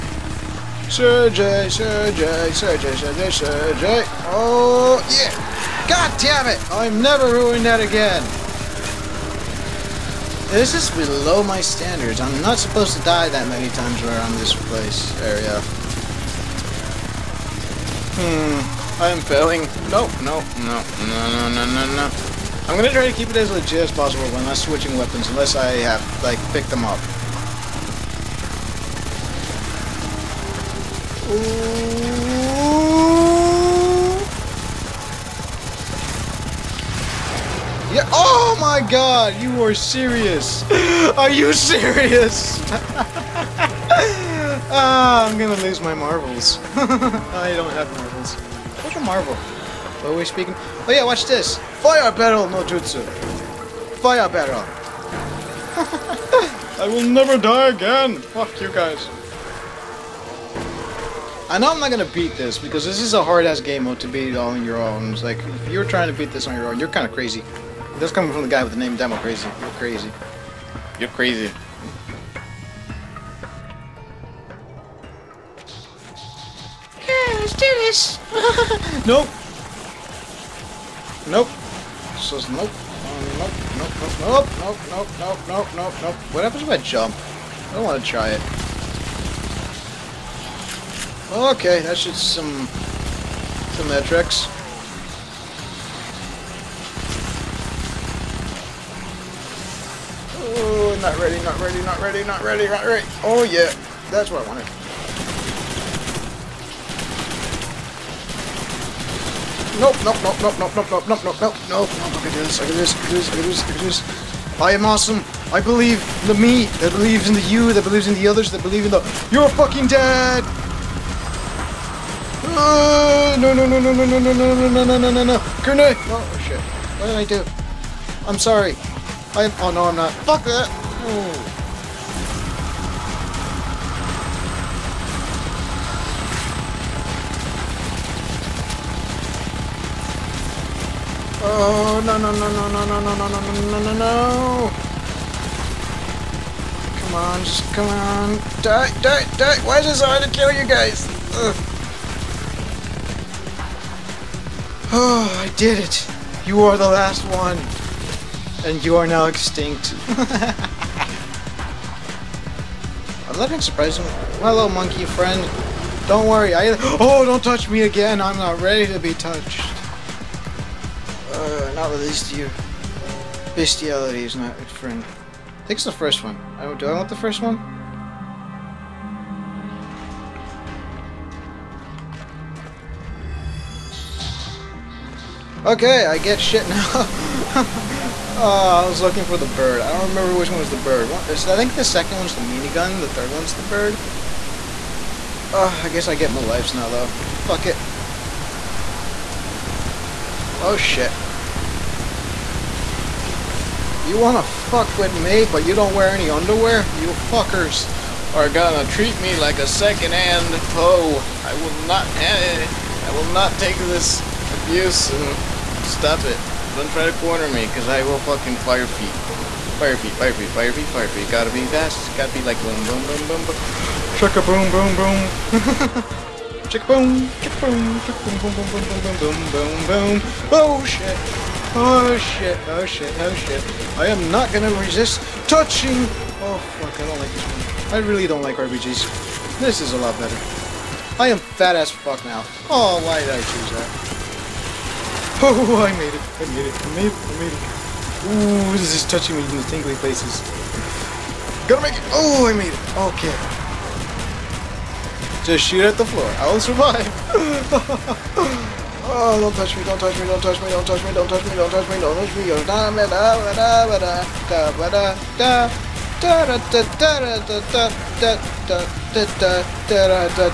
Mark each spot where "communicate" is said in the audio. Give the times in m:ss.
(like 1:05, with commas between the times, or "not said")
not said.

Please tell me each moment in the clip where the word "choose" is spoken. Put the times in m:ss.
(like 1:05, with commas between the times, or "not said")
4:03.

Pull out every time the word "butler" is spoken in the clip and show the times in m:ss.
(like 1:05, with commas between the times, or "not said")
not said.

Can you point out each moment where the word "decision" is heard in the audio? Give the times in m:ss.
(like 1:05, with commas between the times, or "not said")
not said.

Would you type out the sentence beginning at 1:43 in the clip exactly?
Oh yeah, that's what I wanted.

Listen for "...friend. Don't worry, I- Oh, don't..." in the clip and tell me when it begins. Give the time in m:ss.
2:45.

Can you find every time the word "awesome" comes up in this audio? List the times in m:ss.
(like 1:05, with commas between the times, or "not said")
1:54.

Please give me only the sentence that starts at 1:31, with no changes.
Okay, that's just some some metrics.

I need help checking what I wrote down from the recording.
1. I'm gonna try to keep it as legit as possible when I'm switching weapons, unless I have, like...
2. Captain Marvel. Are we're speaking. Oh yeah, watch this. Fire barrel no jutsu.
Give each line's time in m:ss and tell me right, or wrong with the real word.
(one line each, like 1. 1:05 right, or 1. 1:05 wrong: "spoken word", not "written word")
1. 0:22 right
2. 0:48 right.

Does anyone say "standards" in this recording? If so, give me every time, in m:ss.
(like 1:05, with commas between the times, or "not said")
0:11.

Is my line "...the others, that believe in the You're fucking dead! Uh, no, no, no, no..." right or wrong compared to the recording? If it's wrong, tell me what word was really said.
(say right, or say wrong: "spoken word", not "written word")
right.